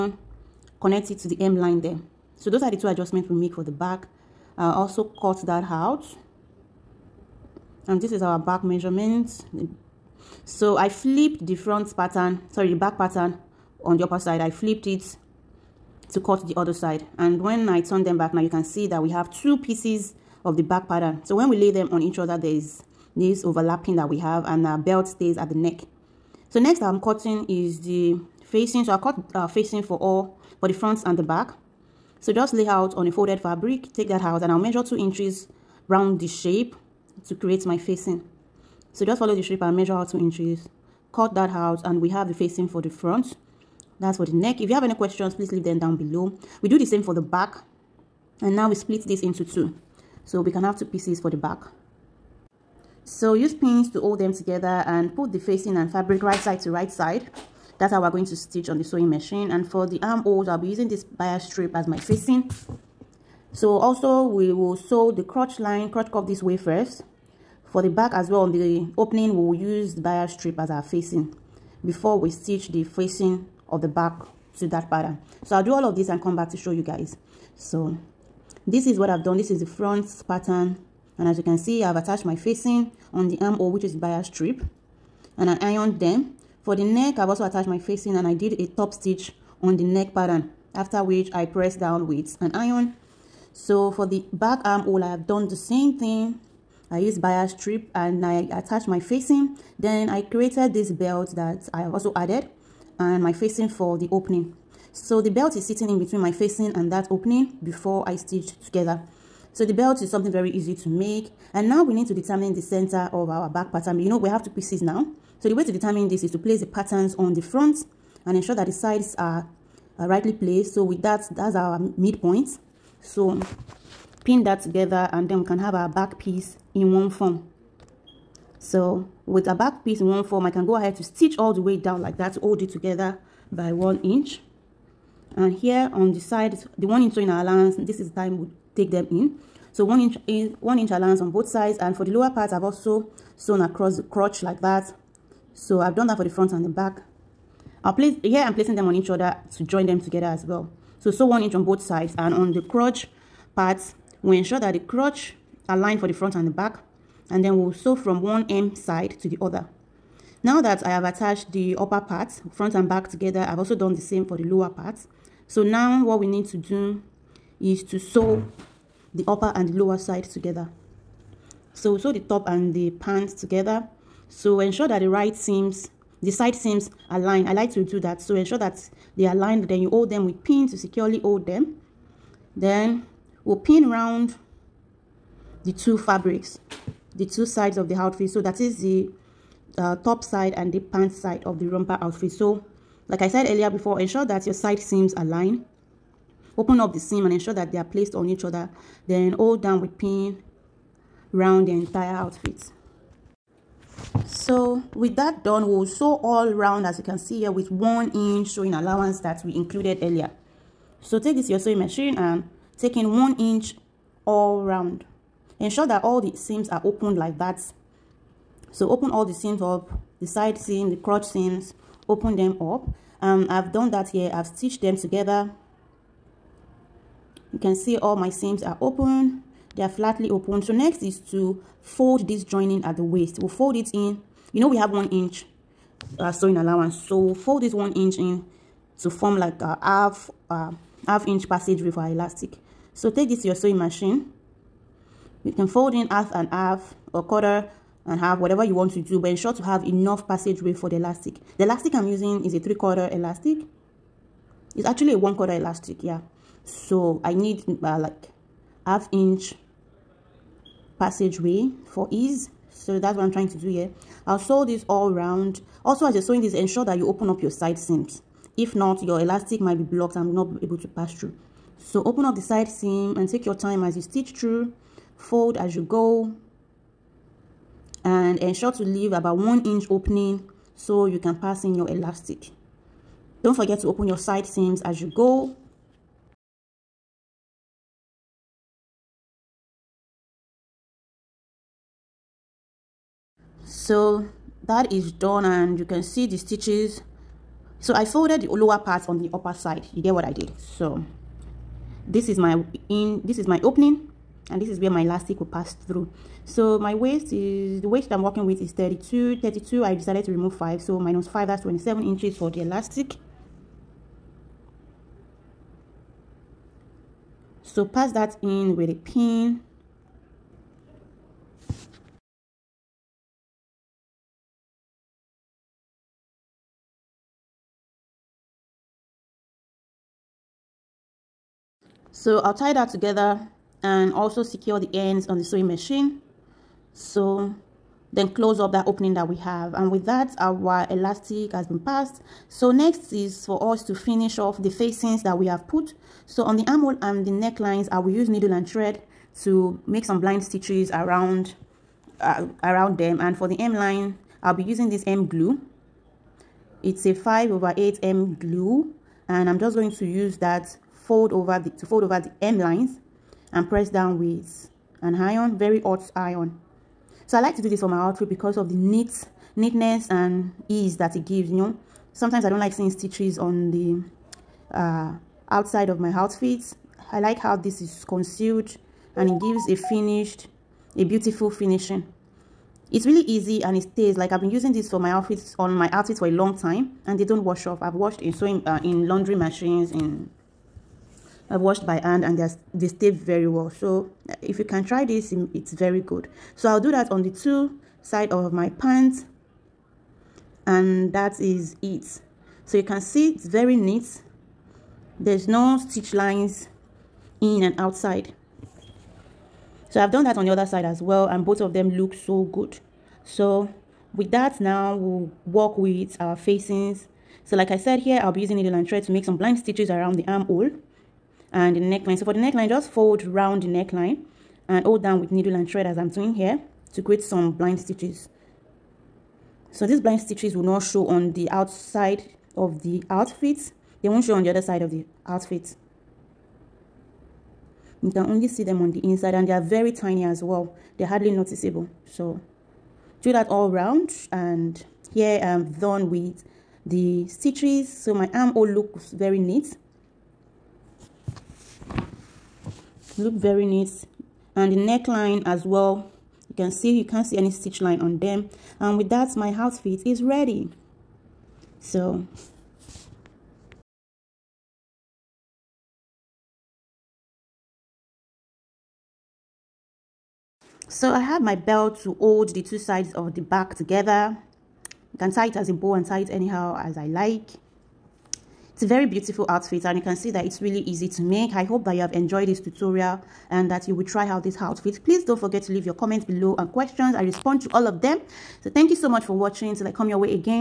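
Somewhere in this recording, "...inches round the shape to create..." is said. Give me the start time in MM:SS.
00:34.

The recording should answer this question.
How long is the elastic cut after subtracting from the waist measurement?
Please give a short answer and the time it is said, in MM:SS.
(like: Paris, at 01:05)
27 inches, at 05:11.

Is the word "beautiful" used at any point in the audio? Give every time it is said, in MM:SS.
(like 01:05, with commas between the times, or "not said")
06:21, 07:59.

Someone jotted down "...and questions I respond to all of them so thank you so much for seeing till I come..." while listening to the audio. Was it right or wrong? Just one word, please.
wrong.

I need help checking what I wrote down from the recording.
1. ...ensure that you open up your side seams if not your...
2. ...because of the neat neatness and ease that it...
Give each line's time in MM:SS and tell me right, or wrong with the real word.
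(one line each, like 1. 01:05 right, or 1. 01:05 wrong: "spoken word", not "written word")
1. 04:26 right
2. 06:08 right.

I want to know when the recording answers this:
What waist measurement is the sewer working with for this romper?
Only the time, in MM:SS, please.
05:08.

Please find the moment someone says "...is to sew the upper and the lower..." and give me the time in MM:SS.
02:47.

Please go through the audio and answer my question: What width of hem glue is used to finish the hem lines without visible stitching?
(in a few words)
5/8.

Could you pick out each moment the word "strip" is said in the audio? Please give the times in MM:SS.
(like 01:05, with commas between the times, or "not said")
01:01, 01:10, 01:24, 01:37.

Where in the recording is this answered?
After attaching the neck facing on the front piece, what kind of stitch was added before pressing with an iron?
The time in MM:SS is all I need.
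01:28.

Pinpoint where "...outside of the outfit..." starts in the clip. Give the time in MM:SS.
07:11.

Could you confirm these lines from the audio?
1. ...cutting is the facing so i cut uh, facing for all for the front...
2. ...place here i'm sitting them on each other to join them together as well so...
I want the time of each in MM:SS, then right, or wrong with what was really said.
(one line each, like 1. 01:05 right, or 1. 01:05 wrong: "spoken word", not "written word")
1. 00:27 right
2. 02:27 wrong: "placing", not "sitting".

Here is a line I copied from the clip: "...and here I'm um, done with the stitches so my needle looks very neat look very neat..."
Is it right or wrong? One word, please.
wrong.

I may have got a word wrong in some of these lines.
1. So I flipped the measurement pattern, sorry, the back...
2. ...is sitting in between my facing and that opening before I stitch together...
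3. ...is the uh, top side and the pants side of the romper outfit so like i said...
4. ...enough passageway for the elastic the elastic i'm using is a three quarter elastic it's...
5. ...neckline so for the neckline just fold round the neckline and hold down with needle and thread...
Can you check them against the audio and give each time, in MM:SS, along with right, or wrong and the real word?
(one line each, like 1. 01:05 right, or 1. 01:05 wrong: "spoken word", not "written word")
1. 00:10 wrong: "front", not "measurement"
2. 01:45 right
3. 03:08 right
4. 04:09 right
5. 07:01 right.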